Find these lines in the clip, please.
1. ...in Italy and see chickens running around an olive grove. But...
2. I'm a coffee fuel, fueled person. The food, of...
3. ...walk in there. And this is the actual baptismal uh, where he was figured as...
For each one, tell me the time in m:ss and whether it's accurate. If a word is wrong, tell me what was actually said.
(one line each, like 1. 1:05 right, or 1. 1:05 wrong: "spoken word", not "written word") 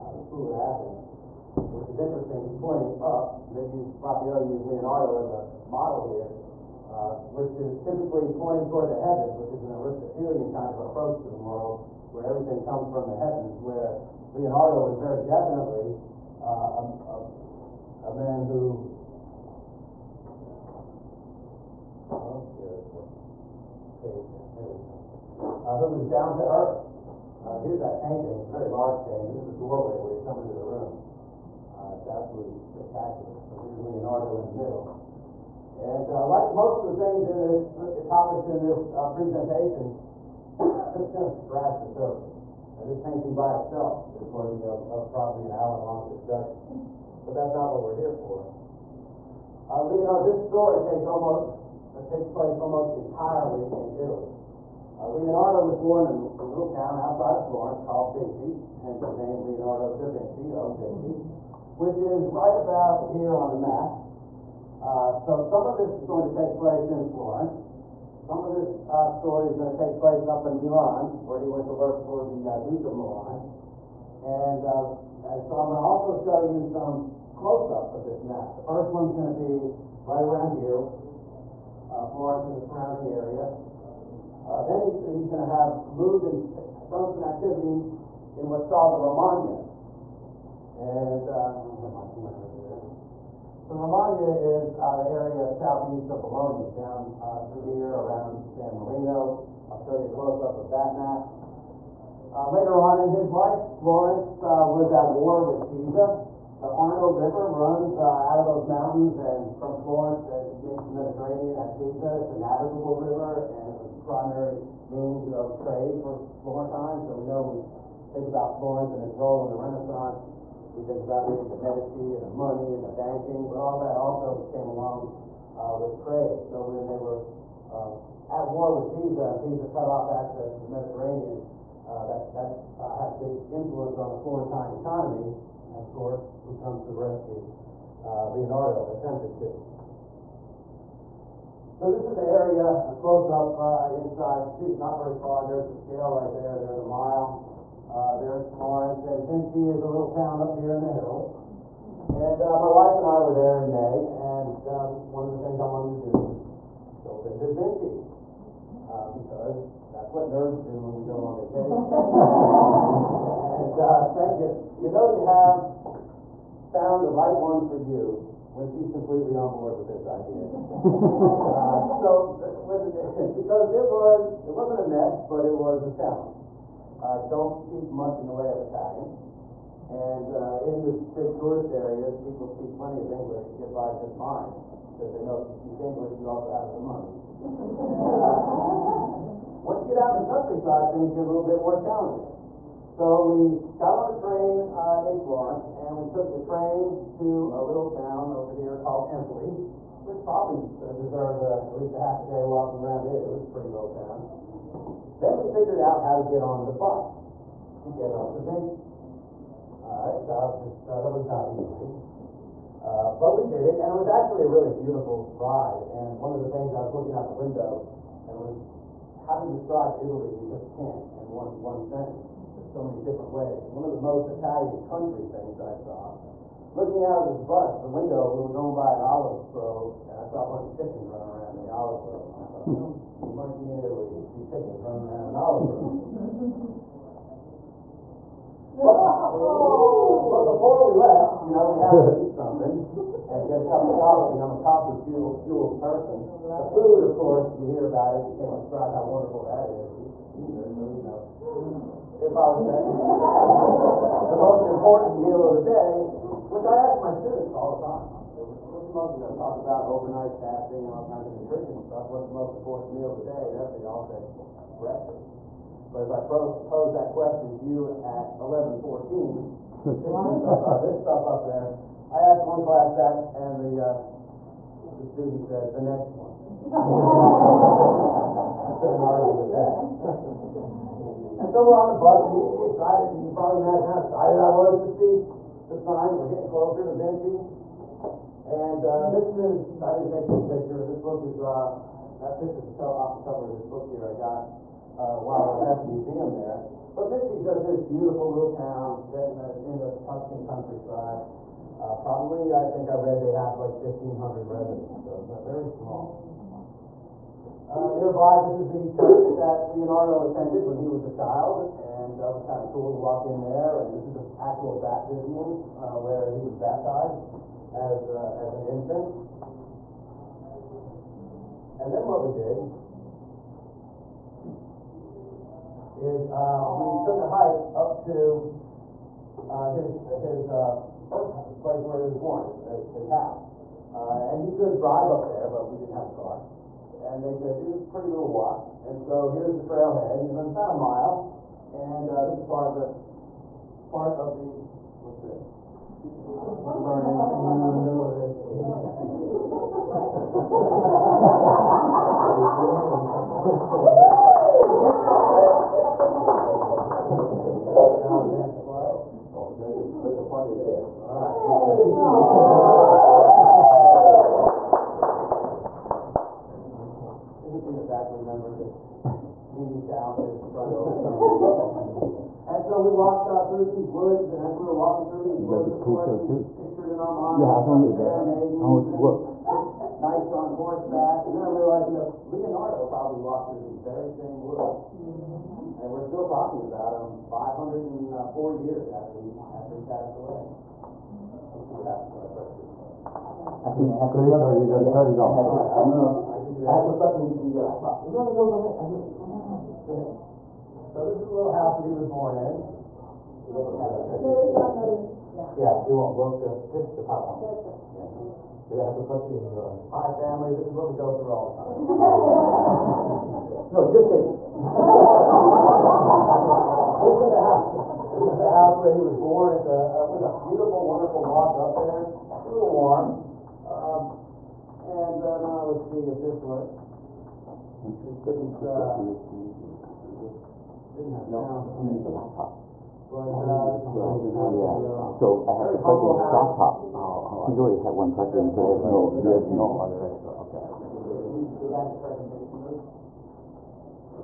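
1. 3:53 right
2. 4:04 right
3. 5:12 wrong: "baptized", not "figured".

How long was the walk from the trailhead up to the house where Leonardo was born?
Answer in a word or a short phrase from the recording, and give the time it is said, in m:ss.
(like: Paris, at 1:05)
About a mile, at 5:40.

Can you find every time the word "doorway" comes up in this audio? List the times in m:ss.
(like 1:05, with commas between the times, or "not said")
0:29.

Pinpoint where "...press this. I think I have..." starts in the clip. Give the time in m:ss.
6:32.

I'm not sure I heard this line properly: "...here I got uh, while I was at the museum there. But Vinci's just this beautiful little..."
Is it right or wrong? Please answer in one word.
right.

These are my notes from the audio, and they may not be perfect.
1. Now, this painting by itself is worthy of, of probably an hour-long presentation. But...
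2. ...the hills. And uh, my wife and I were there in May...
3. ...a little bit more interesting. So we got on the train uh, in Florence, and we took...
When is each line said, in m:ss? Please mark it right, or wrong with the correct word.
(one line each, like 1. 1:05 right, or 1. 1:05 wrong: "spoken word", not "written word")
1. 0:42 wrong: "discussion", not "presentation"
2. 2:30 right
3. 3:11 wrong: "challenging", not "interesting".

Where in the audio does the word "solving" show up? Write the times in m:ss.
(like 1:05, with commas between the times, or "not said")
not said.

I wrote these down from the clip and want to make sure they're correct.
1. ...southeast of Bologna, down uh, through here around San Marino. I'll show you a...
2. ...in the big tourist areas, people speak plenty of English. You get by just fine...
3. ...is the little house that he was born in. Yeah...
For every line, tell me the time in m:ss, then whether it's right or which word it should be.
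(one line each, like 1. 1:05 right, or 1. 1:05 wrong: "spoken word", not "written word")
1. 1:35 right
2. 3:00 right
3. 6:41 right.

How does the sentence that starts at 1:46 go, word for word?
The Arno River runs uh, out of those mountains, and from Florence it makes the Mediterranean at Pisa.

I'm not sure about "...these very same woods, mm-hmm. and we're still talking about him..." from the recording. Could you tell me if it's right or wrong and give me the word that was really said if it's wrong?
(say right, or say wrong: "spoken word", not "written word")
right.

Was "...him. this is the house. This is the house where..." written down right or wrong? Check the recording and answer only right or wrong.
right.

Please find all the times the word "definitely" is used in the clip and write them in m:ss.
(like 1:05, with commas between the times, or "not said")
0:15.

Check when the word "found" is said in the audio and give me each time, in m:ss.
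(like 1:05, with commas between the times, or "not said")
2:46.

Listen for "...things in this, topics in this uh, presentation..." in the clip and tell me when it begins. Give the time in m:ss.
0:37.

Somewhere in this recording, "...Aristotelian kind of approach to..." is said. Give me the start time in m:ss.
0:09.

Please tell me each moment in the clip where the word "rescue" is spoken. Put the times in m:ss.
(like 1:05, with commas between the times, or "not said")
2:16.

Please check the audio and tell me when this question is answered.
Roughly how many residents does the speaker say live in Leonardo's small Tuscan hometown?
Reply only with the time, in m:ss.
5:03.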